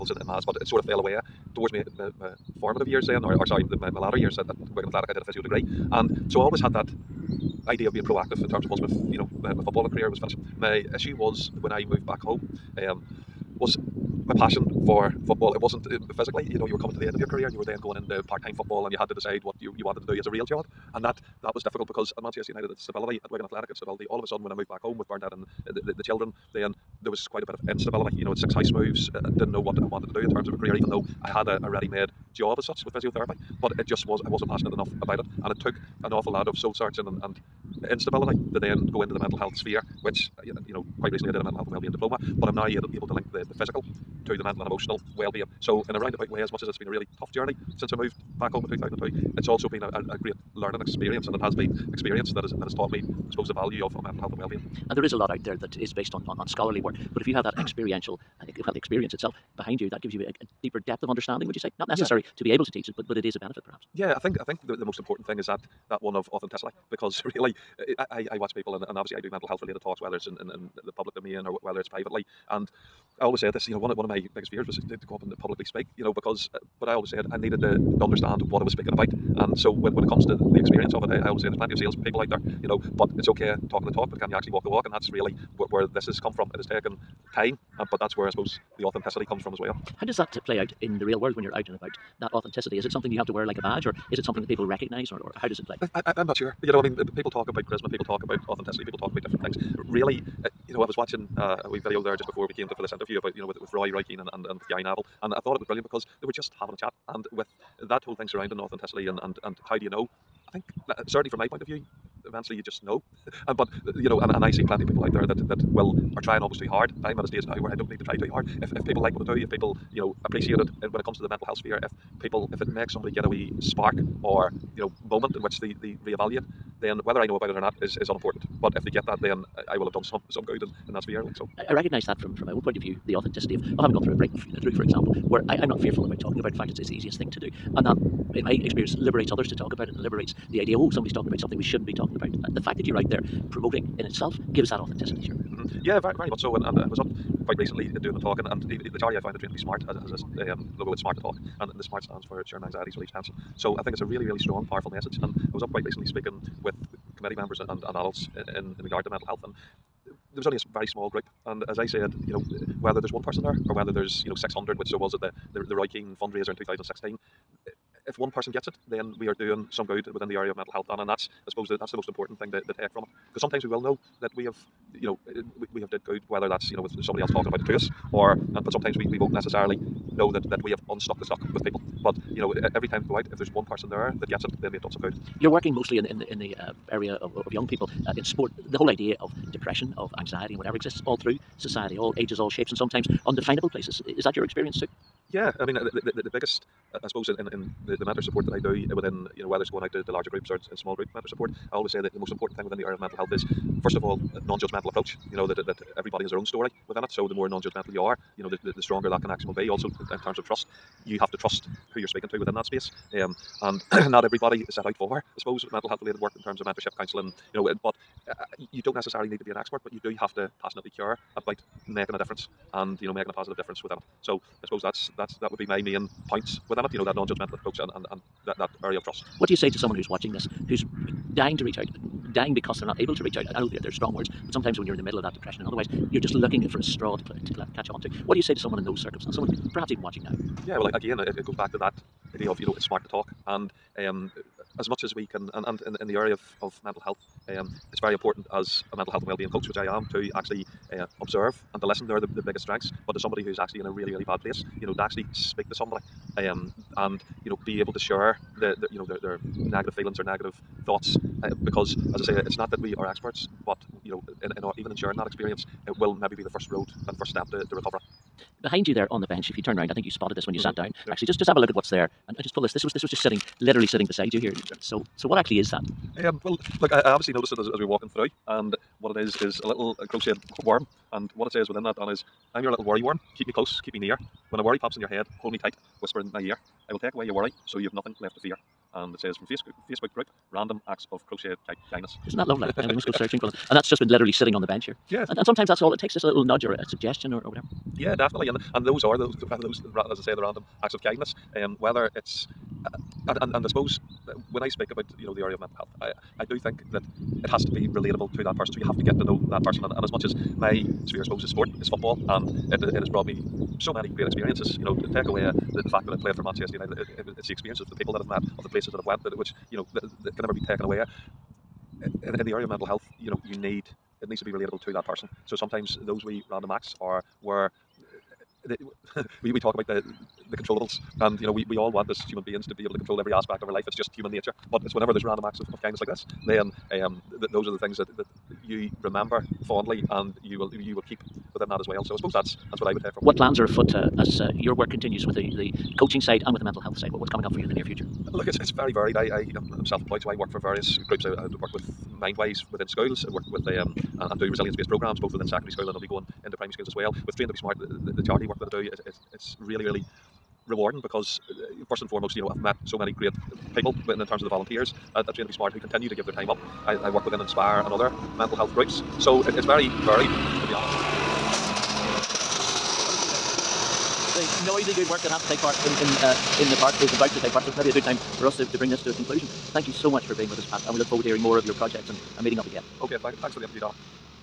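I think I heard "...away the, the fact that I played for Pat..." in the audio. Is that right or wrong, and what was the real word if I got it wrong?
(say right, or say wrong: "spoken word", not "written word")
wrong: "Manchester", not "Pat".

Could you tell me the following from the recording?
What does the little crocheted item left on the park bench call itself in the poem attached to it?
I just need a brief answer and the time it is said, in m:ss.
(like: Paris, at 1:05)
Worry worm, at 4:42.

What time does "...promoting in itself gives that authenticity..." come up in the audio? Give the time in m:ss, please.
2:23.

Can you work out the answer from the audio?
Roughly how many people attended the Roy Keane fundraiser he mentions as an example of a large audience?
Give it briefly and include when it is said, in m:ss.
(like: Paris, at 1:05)
600, at 2:44.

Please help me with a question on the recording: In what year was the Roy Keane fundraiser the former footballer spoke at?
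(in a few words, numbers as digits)
2016.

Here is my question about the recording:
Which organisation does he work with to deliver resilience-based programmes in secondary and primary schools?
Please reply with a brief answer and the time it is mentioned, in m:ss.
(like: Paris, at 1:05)
Mindwise, at 5:52.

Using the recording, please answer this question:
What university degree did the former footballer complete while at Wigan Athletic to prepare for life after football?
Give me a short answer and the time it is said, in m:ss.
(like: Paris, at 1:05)
Physio degree, at 0:05.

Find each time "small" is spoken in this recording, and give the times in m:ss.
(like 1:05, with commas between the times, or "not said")
2:40, 3:20.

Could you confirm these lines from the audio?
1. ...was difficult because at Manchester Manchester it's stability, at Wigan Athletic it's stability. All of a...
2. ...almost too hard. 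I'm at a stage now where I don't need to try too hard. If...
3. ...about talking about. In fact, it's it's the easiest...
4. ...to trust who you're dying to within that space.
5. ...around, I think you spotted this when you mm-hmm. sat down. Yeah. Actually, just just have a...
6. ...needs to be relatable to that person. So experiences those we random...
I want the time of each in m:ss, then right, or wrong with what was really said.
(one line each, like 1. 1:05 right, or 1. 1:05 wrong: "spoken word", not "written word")
1. 0:21 wrong: "United", not "Manchester"
2. 1:56 right
3. 2:16 right
4. 3:31 wrong: "speaking", not "dying"
5. 4:29 right
6. 5:24 wrong: "sometimes", not "experiences".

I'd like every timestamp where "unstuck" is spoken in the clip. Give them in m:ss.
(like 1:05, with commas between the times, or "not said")
3:00.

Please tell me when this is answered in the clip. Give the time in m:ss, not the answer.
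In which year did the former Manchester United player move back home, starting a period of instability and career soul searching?
0:48.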